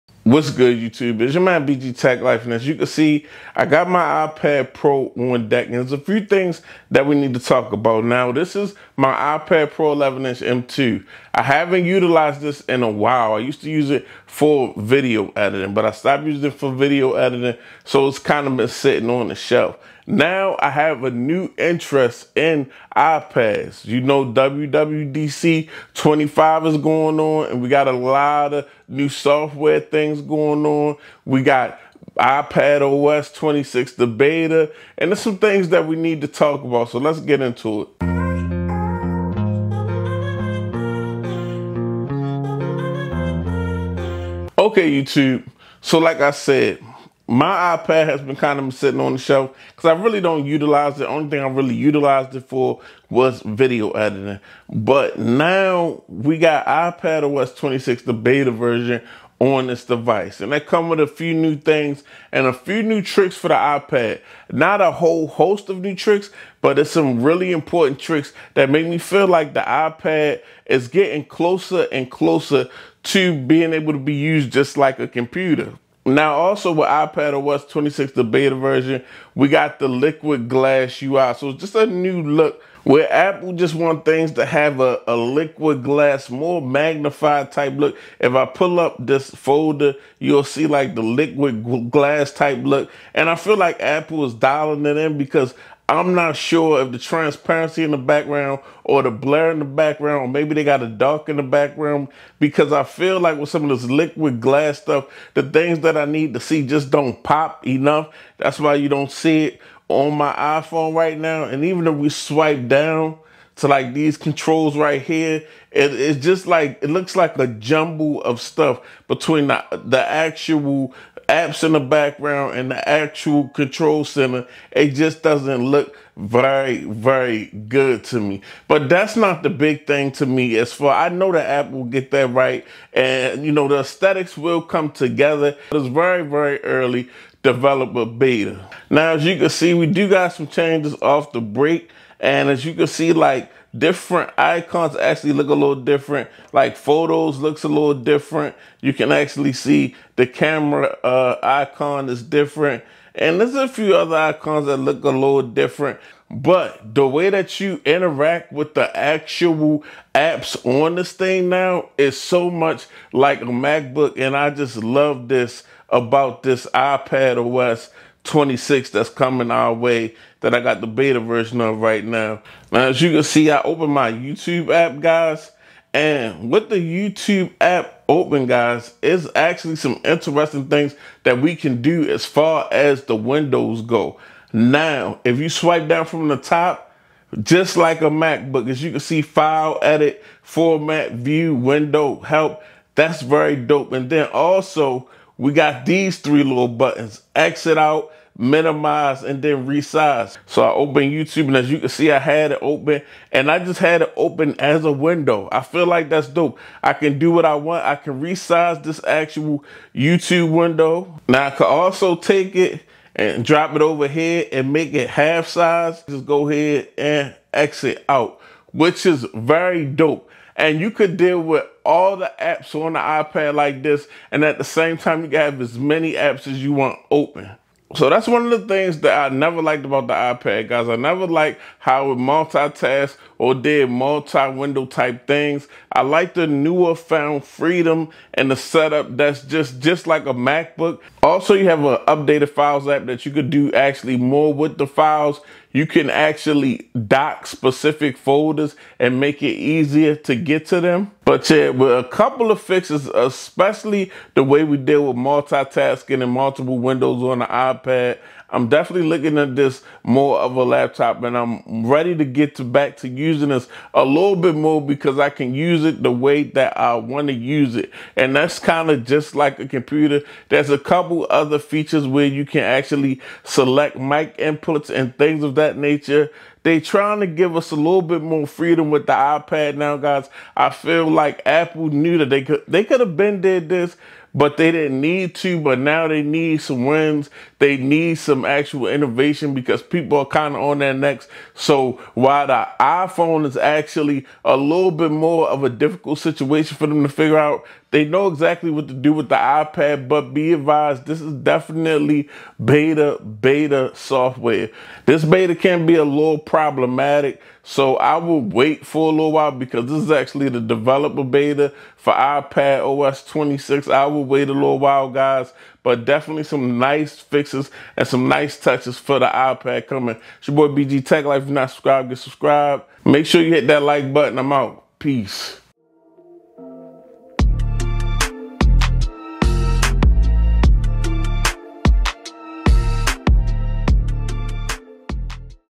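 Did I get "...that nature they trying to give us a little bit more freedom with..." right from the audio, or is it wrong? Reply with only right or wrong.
right.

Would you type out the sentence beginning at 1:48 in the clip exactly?
That's why you don't see it on my iPhone right now.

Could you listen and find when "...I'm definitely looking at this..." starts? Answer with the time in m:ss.
4:18.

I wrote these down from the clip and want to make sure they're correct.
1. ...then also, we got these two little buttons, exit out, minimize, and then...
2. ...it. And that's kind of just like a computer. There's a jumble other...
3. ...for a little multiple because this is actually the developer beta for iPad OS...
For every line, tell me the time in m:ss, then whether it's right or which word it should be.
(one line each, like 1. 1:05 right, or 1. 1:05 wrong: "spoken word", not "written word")
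1. 3:14 wrong: "three", not "two"
2. 4:27 wrong: "couple", not "jumble"
3. 5:08 wrong: "while", not "multiple".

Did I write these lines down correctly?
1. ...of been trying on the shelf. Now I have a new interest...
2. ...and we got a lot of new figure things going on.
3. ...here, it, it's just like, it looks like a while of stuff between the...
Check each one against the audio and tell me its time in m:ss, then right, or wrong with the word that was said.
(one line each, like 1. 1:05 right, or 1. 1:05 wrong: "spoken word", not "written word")
1. 0:18 wrong: "sitting", not "trying"
2. 0:27 wrong: "software", not "figure"
3. 1:55 wrong: "jumble", not "while".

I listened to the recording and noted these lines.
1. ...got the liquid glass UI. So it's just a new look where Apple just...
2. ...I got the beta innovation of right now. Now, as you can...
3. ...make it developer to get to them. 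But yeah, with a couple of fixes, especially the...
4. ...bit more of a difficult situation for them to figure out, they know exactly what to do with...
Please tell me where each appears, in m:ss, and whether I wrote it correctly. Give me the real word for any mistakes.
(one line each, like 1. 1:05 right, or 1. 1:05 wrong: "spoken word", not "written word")
1. 1:19 right
2. 2:50 wrong: "version", not "innovation"
3. 4:09 wrong: "easier", not "developer"
4. 4:54 right.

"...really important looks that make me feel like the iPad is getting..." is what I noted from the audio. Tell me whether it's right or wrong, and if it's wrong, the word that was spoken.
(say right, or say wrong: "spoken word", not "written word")
wrong: "tricks", not "looks".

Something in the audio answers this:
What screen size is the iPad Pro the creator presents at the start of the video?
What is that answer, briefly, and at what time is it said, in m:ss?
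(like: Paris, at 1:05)
11 inch, at 0:09.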